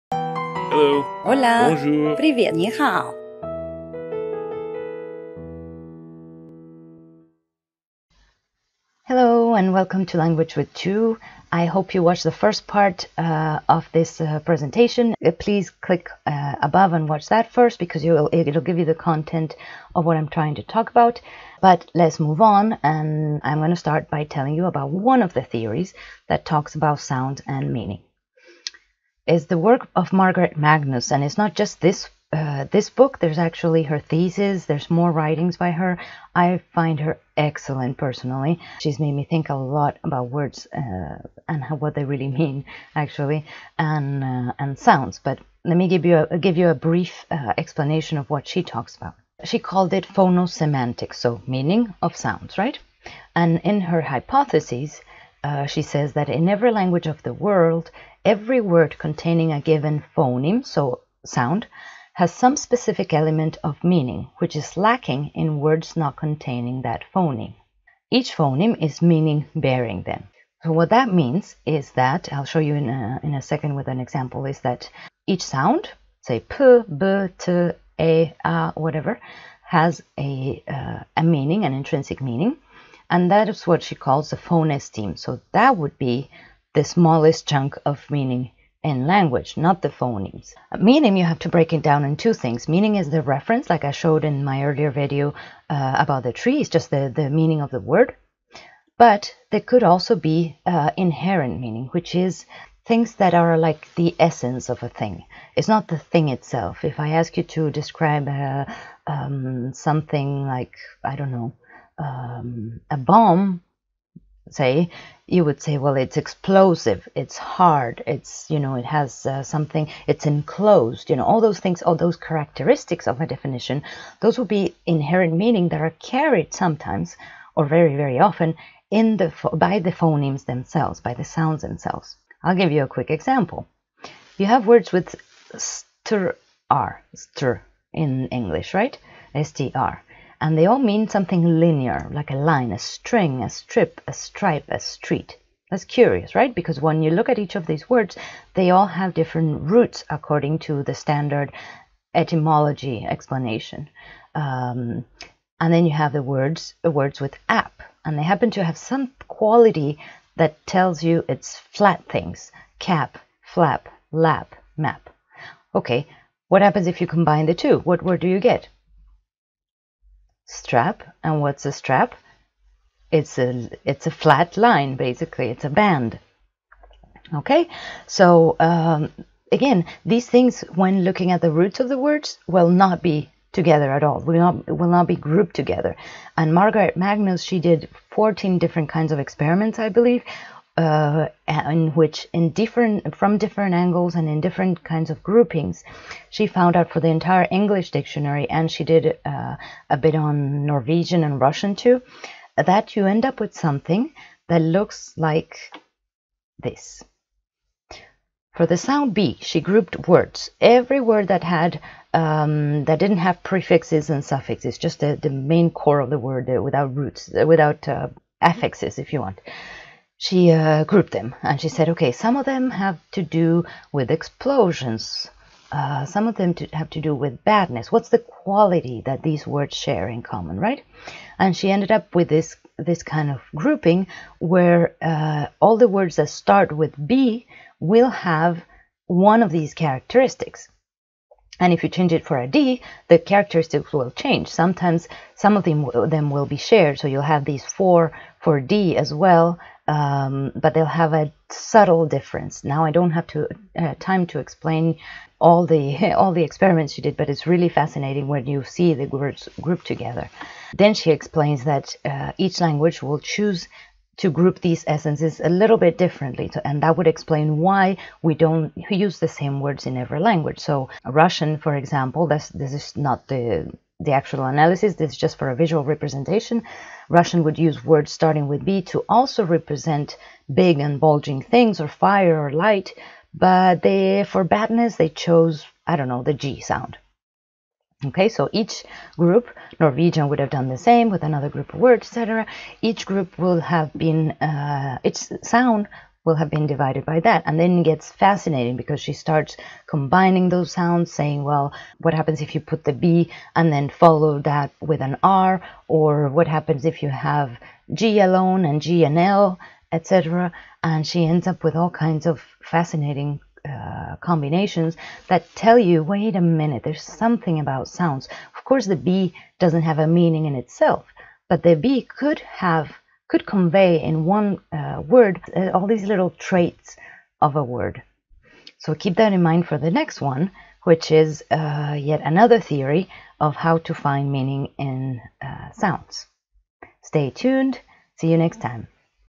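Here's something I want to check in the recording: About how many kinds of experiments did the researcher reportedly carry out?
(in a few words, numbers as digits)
14.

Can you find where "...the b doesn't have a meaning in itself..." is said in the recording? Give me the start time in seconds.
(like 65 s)
318 s.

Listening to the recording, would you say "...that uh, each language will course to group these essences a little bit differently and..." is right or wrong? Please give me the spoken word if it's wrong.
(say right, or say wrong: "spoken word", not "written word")
wrong: "choose", not "course".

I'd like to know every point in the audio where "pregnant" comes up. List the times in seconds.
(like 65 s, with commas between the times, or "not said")
not said.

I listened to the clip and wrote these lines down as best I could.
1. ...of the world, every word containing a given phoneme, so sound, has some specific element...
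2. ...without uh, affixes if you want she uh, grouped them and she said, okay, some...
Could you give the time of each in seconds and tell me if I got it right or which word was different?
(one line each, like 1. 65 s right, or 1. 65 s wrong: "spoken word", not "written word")
1. 57 s right
2. 217 s right.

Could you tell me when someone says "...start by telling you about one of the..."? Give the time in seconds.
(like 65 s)
23 s.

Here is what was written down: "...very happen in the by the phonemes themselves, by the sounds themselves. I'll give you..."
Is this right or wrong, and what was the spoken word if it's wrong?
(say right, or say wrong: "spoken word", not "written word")
wrong: "often", not "happen".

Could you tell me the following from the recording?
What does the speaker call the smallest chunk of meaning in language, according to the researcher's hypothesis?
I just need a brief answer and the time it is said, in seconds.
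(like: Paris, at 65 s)
phonestheme, at 84 s.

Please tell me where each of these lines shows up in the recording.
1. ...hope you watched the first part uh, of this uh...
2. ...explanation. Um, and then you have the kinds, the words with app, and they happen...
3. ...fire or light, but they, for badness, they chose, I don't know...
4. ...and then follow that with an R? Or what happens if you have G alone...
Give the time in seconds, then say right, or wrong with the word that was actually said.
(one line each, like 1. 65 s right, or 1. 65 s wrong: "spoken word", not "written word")
1. 11 s right
2. 153 s wrong: "words", not "kinds"
3. 281 s right
4. 303 s right.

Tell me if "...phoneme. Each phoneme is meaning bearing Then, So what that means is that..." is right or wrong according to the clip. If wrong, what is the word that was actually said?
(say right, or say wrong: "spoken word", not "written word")
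right.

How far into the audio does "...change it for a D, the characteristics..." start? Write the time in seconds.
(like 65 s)
241 s.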